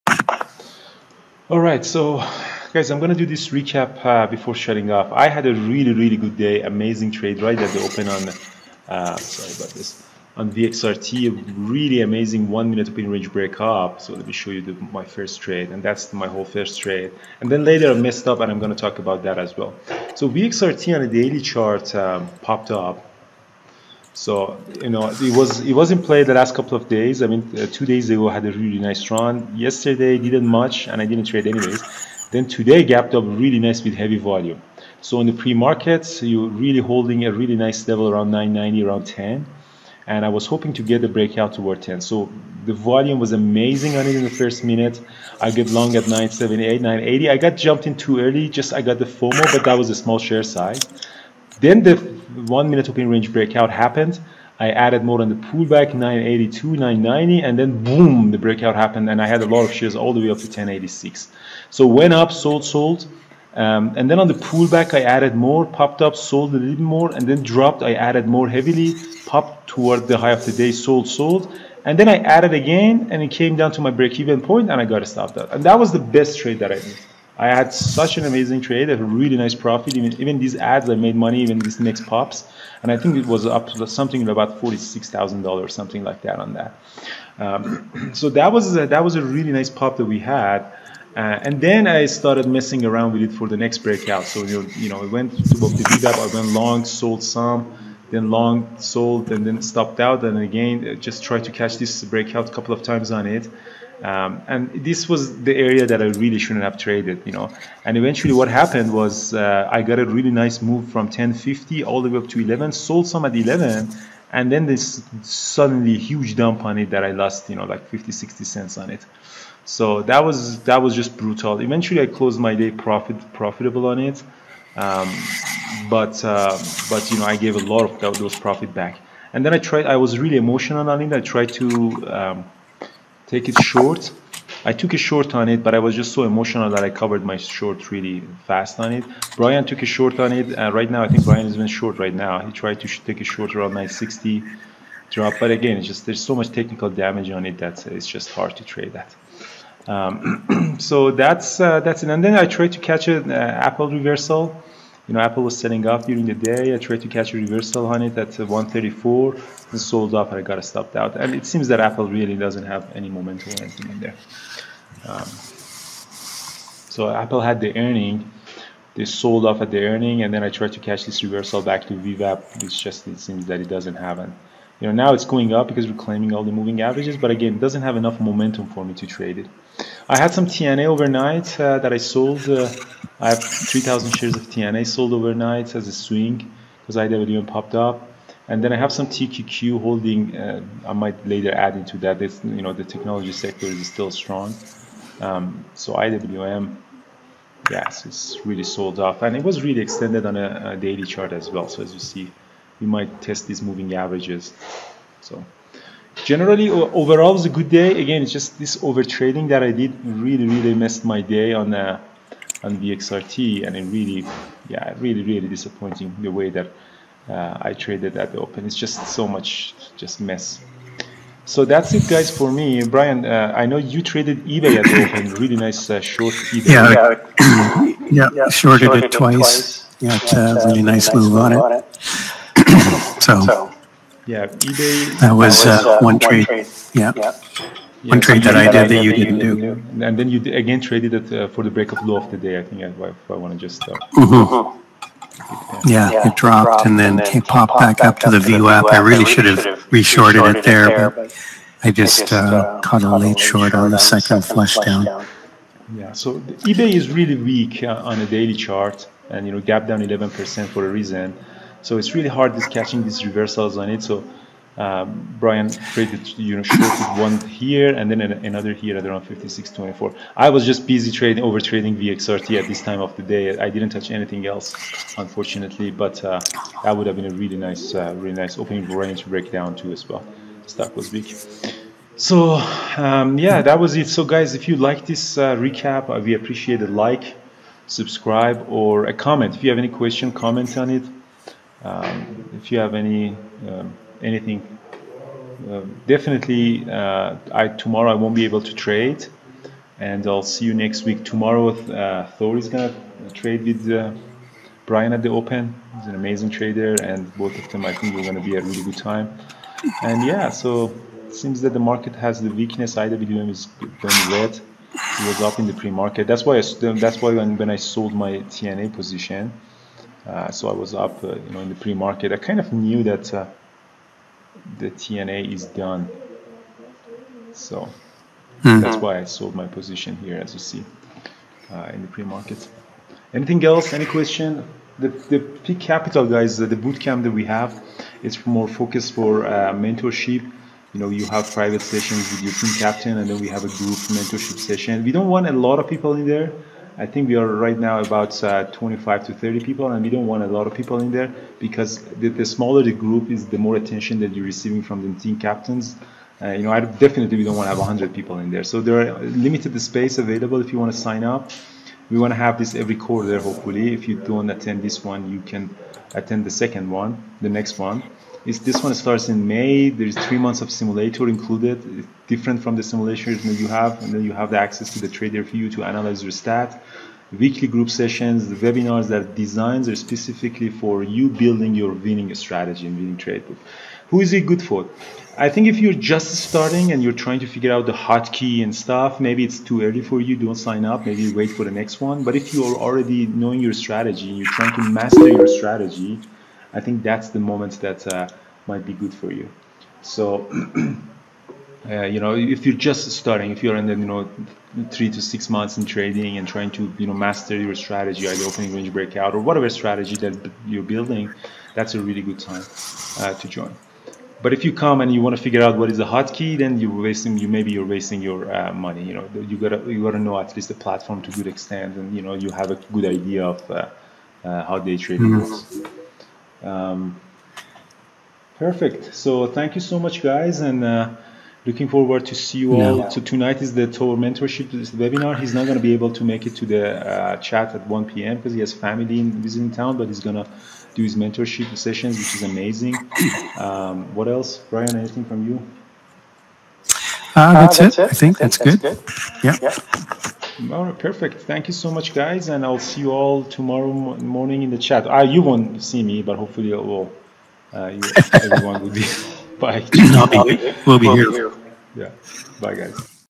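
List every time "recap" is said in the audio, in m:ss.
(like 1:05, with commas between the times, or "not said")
0:03, 4:45.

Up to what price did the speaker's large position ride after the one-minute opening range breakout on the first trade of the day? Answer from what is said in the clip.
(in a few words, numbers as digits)
10.86.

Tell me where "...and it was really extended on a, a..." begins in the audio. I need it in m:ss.
3:19.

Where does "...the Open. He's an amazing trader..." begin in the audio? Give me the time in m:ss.
5:05.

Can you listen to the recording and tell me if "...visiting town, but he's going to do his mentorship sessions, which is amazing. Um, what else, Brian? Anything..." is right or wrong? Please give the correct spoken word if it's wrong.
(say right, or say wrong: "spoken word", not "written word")
right.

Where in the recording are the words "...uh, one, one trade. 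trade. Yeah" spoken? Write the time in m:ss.
3:55.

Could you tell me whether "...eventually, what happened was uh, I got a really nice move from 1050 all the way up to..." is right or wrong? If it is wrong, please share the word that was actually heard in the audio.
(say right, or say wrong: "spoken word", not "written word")
right.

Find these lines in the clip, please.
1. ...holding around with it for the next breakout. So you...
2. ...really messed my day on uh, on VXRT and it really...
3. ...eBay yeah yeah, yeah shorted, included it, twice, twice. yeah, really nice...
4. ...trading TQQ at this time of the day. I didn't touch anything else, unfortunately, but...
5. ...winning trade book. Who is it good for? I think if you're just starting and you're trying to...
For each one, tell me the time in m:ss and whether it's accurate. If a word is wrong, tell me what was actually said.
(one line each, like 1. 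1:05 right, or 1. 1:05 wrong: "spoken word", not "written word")
1. 1:32 wrong: "messing", not "holding"
2. 3:30 right
3. 3:46 wrong: "shorted", not "included"
4. 4:31 wrong: "VXRT", not "TQQ"
5. 6:22 right.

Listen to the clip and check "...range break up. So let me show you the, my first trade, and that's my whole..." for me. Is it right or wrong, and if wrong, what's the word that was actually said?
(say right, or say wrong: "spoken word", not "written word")
right.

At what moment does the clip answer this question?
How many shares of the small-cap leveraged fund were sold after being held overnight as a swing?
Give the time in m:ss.
3:03.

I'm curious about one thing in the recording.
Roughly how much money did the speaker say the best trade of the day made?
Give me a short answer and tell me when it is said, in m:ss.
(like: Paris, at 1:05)
$46,000, at 1:24.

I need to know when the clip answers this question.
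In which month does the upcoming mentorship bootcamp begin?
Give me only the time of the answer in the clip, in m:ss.
6:09.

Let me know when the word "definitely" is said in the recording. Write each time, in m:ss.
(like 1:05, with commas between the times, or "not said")
4:56, 5:56.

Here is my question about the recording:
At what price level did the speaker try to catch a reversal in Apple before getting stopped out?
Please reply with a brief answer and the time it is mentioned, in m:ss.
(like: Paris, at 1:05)
134, at 2:38.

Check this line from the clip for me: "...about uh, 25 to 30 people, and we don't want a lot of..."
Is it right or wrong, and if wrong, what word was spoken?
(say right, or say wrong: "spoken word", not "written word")
right.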